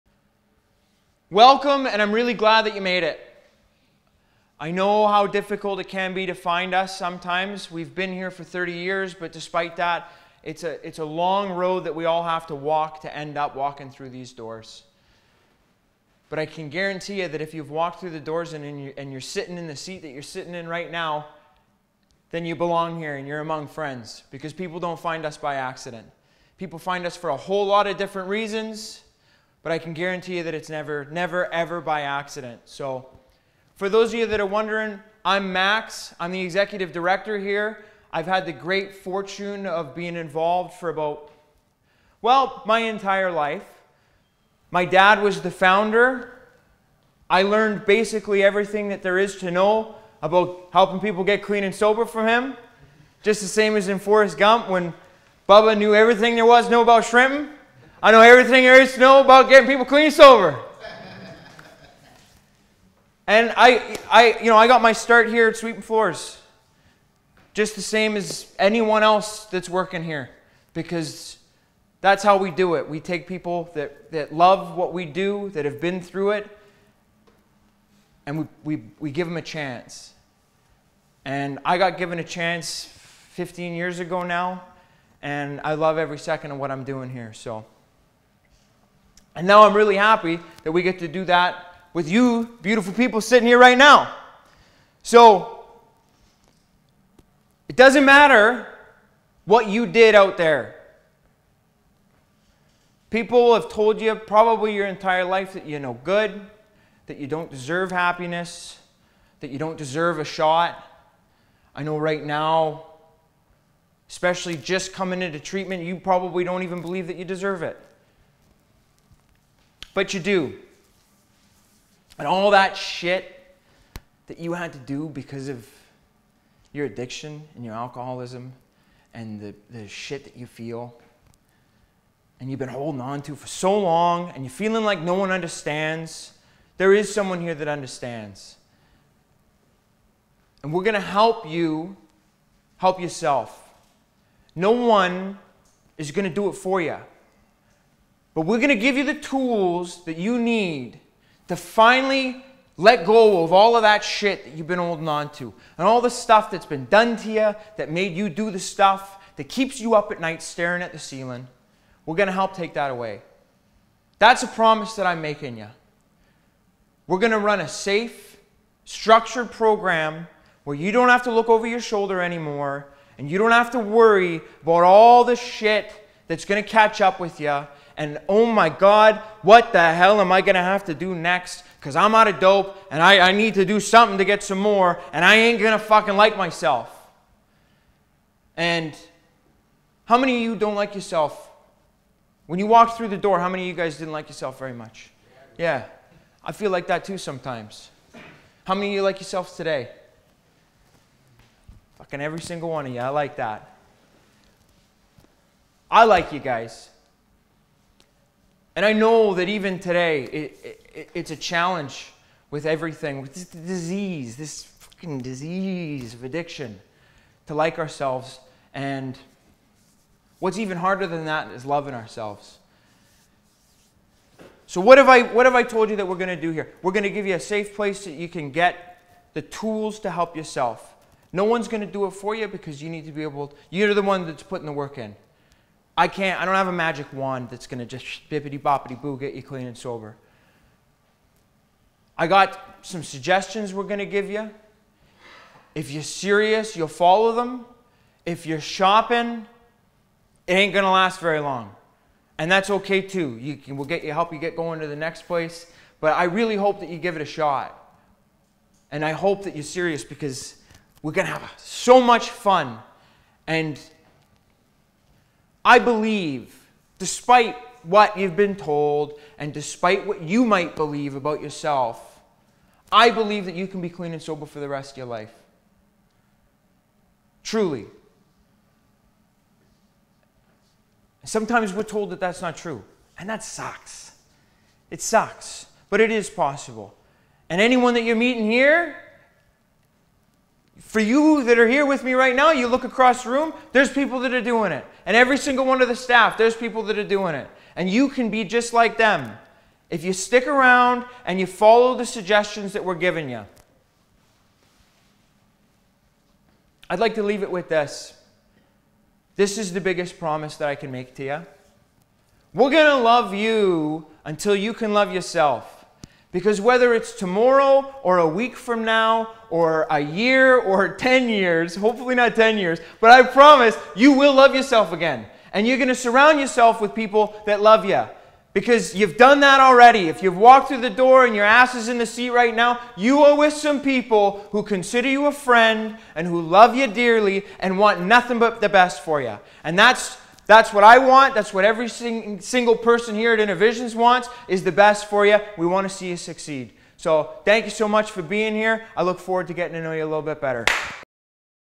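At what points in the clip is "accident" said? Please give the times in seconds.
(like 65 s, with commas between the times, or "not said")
25 s, 32 s.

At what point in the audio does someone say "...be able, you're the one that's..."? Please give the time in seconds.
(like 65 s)
233 s.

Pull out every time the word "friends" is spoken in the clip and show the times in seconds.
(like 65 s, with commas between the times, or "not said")
23 s, 335 s.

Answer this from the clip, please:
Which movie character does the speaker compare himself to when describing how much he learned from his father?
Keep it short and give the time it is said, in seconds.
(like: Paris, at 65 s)
Bubba, at 55 s.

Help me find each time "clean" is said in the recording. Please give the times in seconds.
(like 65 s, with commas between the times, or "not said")
51 s, 59 s, 239 s, 273 s.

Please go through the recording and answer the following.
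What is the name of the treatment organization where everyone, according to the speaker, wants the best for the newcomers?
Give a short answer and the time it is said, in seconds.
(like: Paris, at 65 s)
InnerVisions, at 343 s.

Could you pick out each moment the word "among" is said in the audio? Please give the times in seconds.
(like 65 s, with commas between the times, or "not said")
23 s.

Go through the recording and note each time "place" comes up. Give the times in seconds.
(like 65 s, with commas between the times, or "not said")
227 s, 255 s.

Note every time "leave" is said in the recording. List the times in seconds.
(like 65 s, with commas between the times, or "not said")
307 s.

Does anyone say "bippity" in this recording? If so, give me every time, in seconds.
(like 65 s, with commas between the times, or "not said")
238 s.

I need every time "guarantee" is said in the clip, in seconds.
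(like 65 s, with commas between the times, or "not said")
16 s, 29 s.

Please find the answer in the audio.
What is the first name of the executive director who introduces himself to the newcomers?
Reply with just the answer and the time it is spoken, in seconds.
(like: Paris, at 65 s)
Max, at 35 s.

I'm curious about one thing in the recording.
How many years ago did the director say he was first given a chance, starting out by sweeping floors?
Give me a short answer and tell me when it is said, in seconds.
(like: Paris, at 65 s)
15, at 82 s.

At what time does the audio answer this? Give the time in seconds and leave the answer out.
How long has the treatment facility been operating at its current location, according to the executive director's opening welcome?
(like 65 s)
8 s.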